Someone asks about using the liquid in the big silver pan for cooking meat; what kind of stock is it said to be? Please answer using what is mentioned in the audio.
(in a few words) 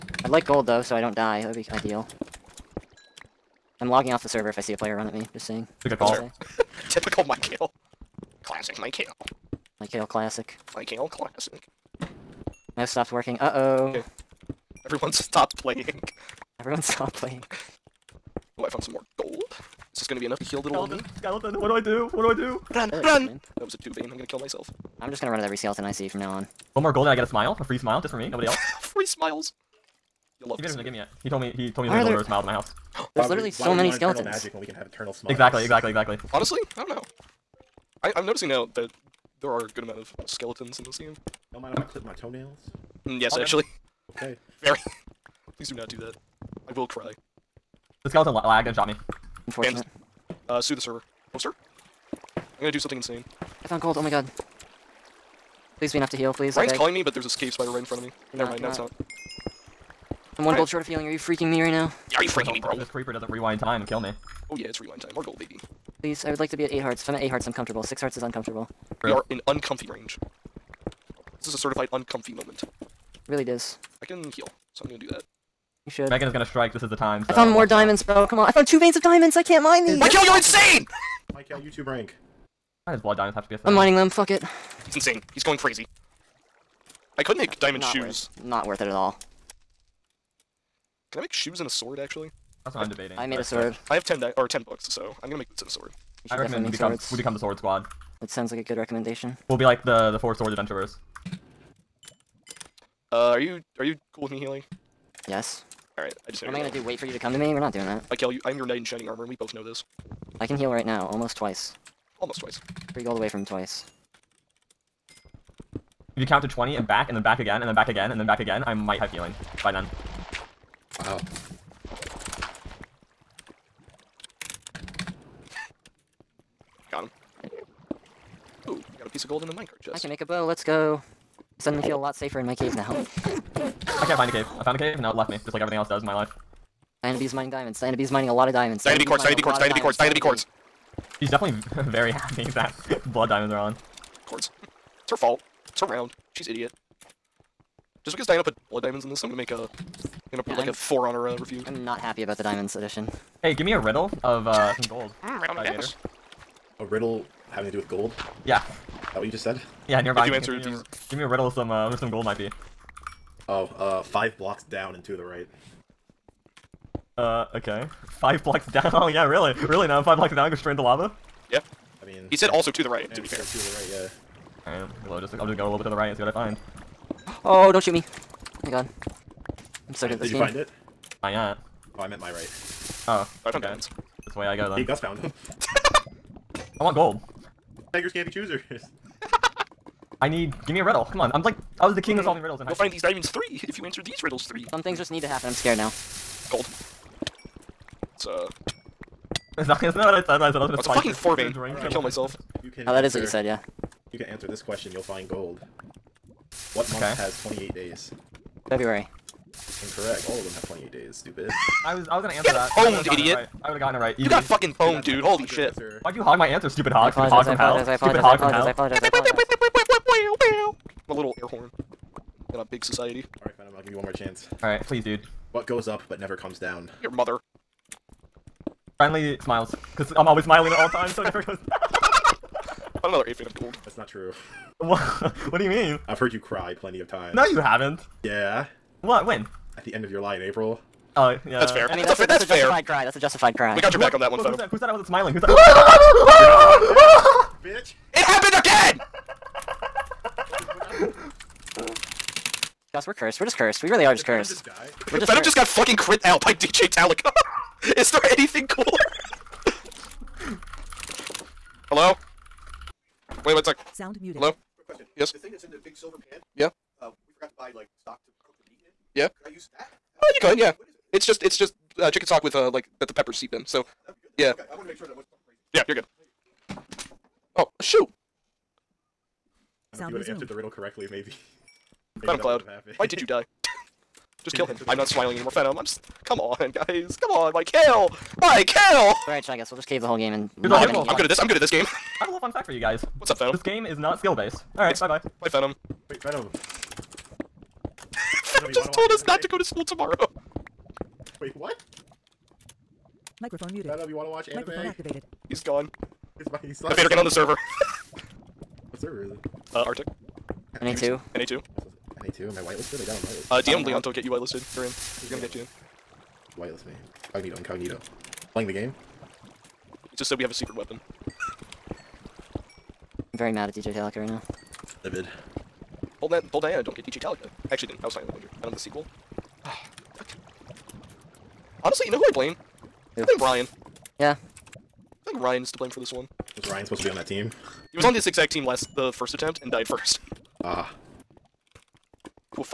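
chicken stock.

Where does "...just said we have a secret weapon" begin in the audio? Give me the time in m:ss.
5:20.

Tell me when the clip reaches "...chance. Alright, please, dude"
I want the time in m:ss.
3:44.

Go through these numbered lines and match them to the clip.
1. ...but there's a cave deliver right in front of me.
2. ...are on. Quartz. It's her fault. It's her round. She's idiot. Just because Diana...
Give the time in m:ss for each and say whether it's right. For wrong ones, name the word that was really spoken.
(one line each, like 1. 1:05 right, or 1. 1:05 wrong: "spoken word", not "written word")
1. 0:57 wrong: "spider", not "deliver"
2. 2:23 right.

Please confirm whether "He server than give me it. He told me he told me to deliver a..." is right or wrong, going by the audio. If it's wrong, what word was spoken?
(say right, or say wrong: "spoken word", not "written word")
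wrong: "better", not "server".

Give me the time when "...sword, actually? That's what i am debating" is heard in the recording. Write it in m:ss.
1:31.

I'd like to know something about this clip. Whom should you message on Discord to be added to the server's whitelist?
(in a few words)
Leon.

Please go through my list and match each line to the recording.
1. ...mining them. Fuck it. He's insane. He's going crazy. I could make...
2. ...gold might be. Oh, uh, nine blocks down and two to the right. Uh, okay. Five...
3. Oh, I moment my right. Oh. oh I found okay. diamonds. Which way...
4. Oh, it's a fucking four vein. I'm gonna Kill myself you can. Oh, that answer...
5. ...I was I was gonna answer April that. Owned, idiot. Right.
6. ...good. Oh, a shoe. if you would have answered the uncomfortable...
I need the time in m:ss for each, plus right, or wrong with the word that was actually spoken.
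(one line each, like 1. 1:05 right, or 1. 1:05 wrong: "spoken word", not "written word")
1. 1:23 right
2. 2:42 wrong: "five", not "nine"
3. 3:01 wrong: "meant", not "moment"
4. 3:20 right
5. 3:31 wrong: "Get", not "April"
6. 4:35 wrong: "riddle", not "uncomfortable".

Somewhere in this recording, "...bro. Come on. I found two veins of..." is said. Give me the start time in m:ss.
1:18.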